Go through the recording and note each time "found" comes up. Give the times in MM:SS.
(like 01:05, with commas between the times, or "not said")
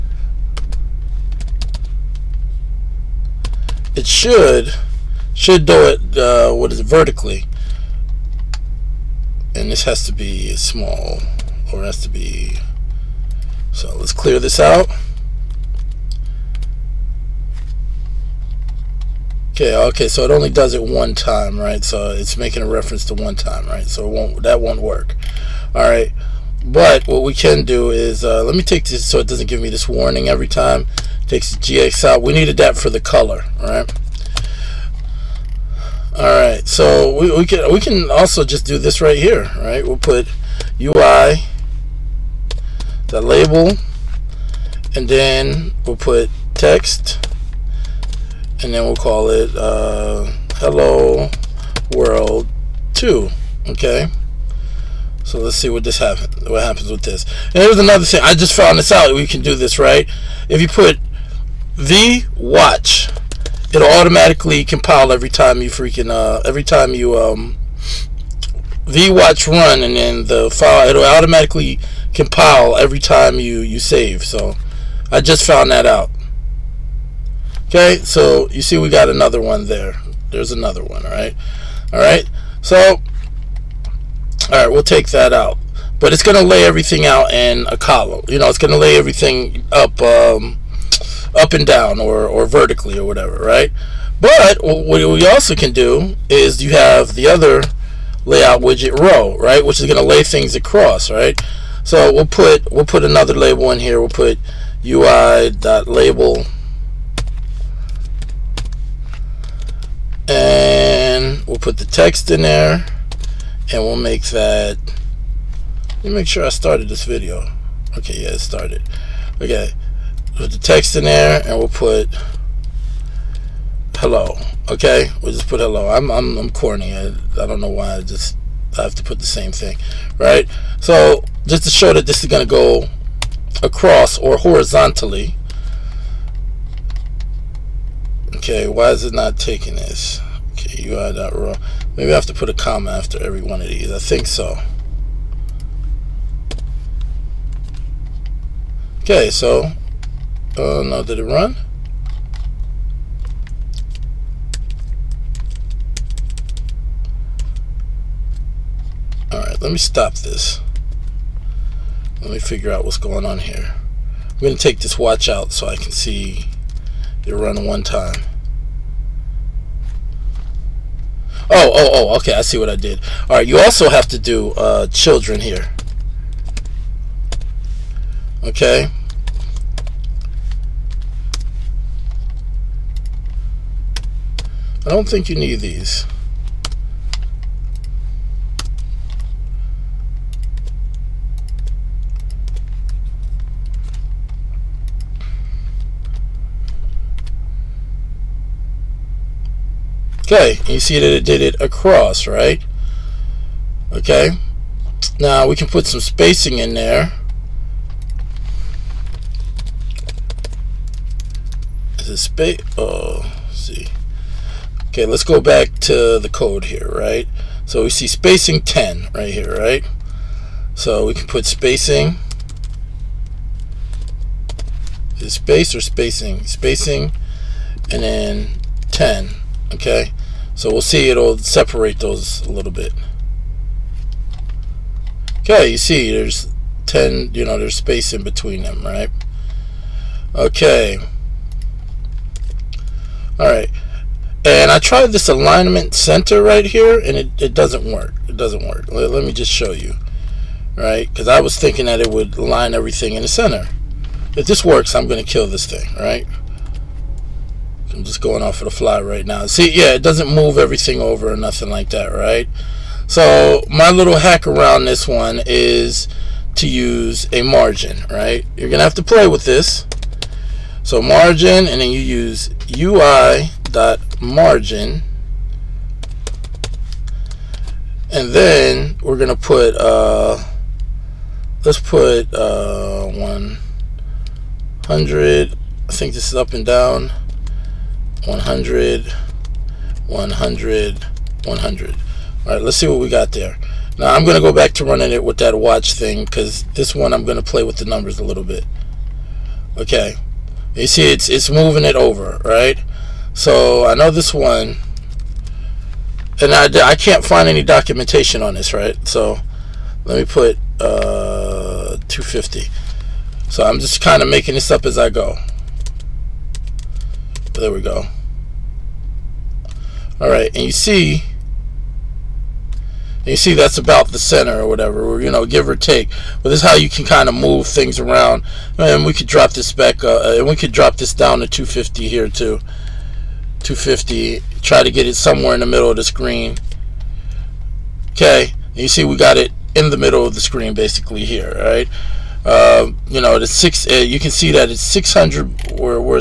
00:58, 01:15.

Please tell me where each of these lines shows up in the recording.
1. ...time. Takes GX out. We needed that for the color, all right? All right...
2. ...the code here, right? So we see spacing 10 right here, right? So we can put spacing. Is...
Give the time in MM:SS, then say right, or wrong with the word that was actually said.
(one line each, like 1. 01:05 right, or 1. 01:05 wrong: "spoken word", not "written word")
1. 00:30 right
2. 03:36 right.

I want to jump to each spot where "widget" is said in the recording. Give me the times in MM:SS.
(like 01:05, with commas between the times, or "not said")
01:38.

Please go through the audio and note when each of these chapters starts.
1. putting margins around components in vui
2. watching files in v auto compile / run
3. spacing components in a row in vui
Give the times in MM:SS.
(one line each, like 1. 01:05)
1. 04:21
2. 01:01
3. 03:16.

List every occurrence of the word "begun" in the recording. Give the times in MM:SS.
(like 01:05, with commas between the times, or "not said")
not said.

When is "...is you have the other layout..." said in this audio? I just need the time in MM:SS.
01:36.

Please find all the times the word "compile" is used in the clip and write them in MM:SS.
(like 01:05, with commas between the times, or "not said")
01:04, 01:12.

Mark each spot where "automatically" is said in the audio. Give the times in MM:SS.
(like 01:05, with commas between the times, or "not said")
01:03, 01:11.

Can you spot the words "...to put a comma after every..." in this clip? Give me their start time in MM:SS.
02:22.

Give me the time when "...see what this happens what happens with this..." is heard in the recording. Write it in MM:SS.
00:55.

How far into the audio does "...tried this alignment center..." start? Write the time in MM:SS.
04:04.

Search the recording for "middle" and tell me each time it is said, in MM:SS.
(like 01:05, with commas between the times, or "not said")
05:35, 05:39.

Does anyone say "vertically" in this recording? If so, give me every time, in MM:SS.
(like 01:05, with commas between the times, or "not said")
00:06, 01:32.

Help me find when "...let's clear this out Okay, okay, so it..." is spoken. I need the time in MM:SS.
00:13.